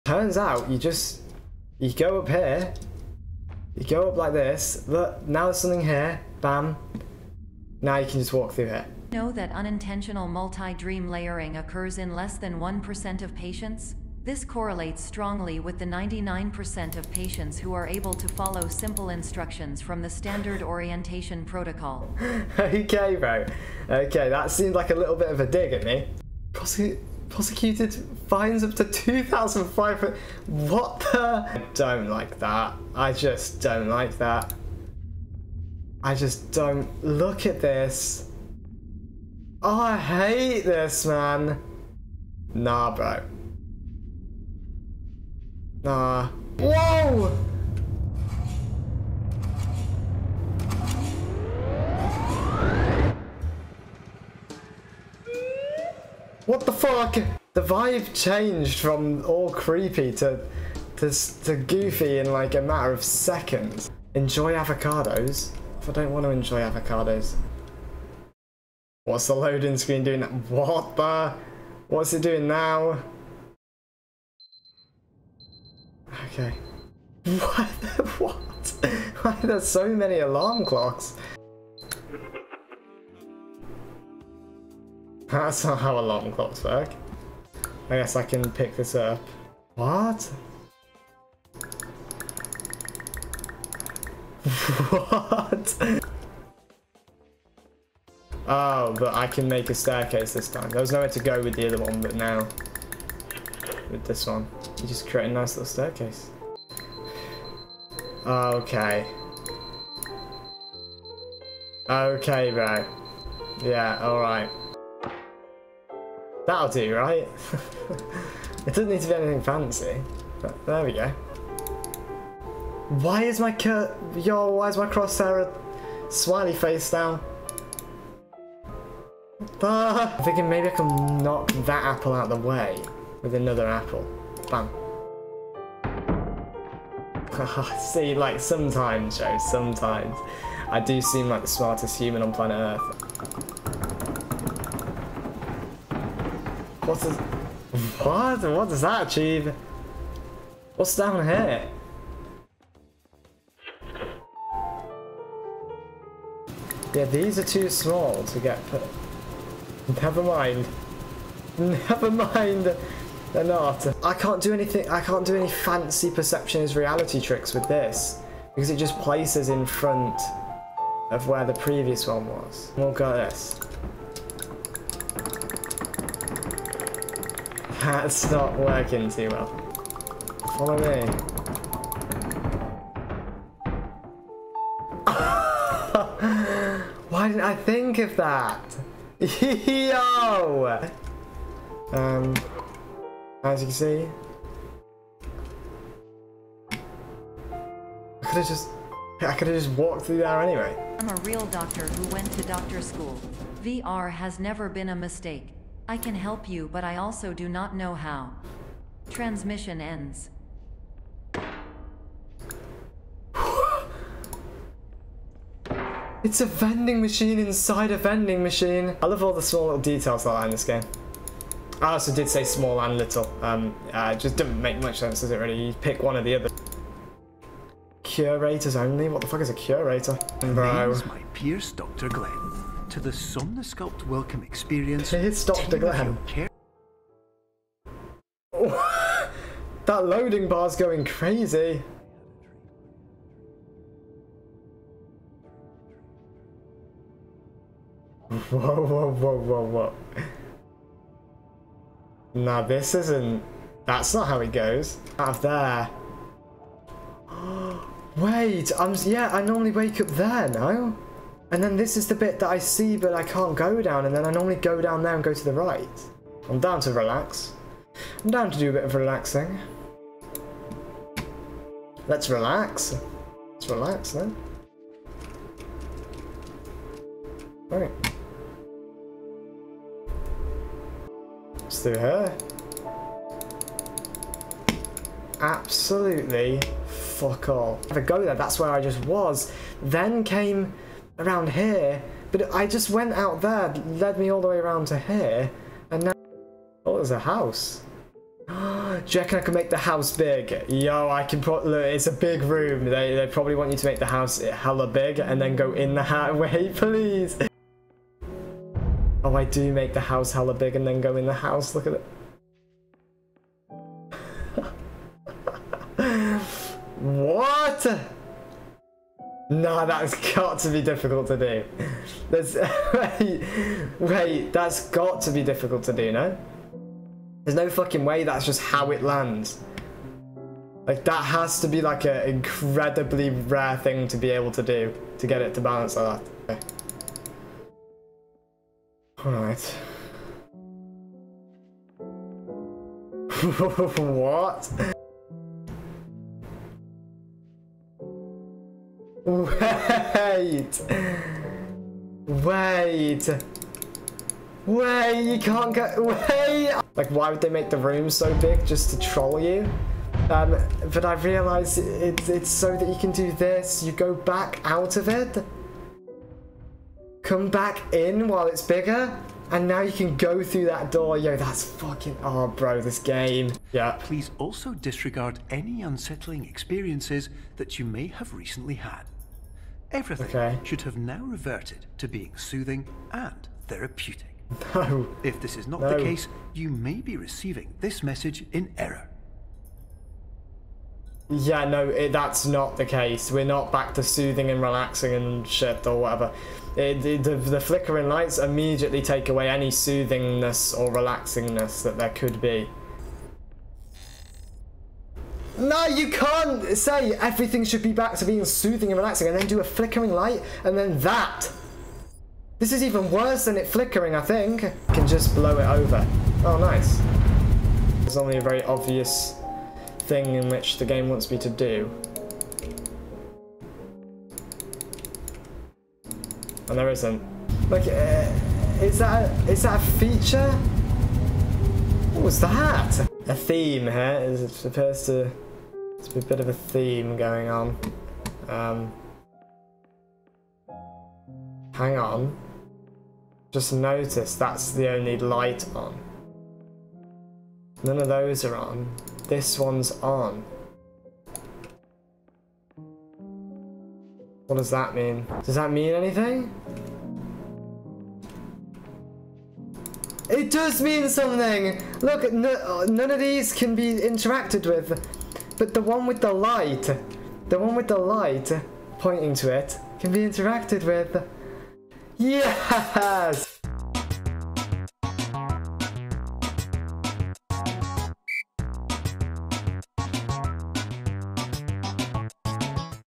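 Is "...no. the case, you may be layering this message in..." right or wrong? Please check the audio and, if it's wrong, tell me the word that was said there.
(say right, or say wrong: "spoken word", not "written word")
wrong: "receiving", not "layering".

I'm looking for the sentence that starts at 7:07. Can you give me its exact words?
Like, uh, is that a, is that a feature?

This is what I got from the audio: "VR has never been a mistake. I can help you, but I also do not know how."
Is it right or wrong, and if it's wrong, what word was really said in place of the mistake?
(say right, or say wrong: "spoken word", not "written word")
right.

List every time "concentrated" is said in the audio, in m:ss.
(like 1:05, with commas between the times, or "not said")
not said.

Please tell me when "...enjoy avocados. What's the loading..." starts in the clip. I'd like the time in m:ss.
1:06.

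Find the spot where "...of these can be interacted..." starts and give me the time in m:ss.
7:43.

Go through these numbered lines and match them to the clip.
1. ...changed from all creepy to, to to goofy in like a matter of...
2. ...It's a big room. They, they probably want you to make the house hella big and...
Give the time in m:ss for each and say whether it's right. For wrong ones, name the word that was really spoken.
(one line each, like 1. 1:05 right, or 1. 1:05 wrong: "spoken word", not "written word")
1. 0:58 right
2. 5:01 right.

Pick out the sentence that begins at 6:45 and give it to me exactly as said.
No, you can't say everything should be back to being soothing and relaxing and then do a flickering light and then that.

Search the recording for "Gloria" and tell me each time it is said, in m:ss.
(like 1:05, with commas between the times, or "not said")
not said.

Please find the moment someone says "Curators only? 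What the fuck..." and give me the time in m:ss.
3:48.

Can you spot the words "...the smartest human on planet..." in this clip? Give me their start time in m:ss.
2:21.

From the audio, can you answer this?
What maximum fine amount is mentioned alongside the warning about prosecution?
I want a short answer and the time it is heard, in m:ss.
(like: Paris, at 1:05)
2,500, at 0:28.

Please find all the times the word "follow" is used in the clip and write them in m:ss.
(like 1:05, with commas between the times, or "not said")
0:18, 3:00.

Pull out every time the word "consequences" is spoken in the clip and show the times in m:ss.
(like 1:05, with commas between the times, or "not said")
not said.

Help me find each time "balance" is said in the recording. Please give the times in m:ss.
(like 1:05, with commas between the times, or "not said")
5:35.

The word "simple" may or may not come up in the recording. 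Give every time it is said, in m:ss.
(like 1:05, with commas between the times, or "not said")
0:18.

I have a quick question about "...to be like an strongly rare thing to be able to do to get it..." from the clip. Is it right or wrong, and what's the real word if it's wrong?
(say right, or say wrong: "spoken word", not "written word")
wrong: "incredibly", not "strongly".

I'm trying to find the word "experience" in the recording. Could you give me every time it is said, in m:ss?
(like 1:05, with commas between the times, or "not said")
3:54, 6:16.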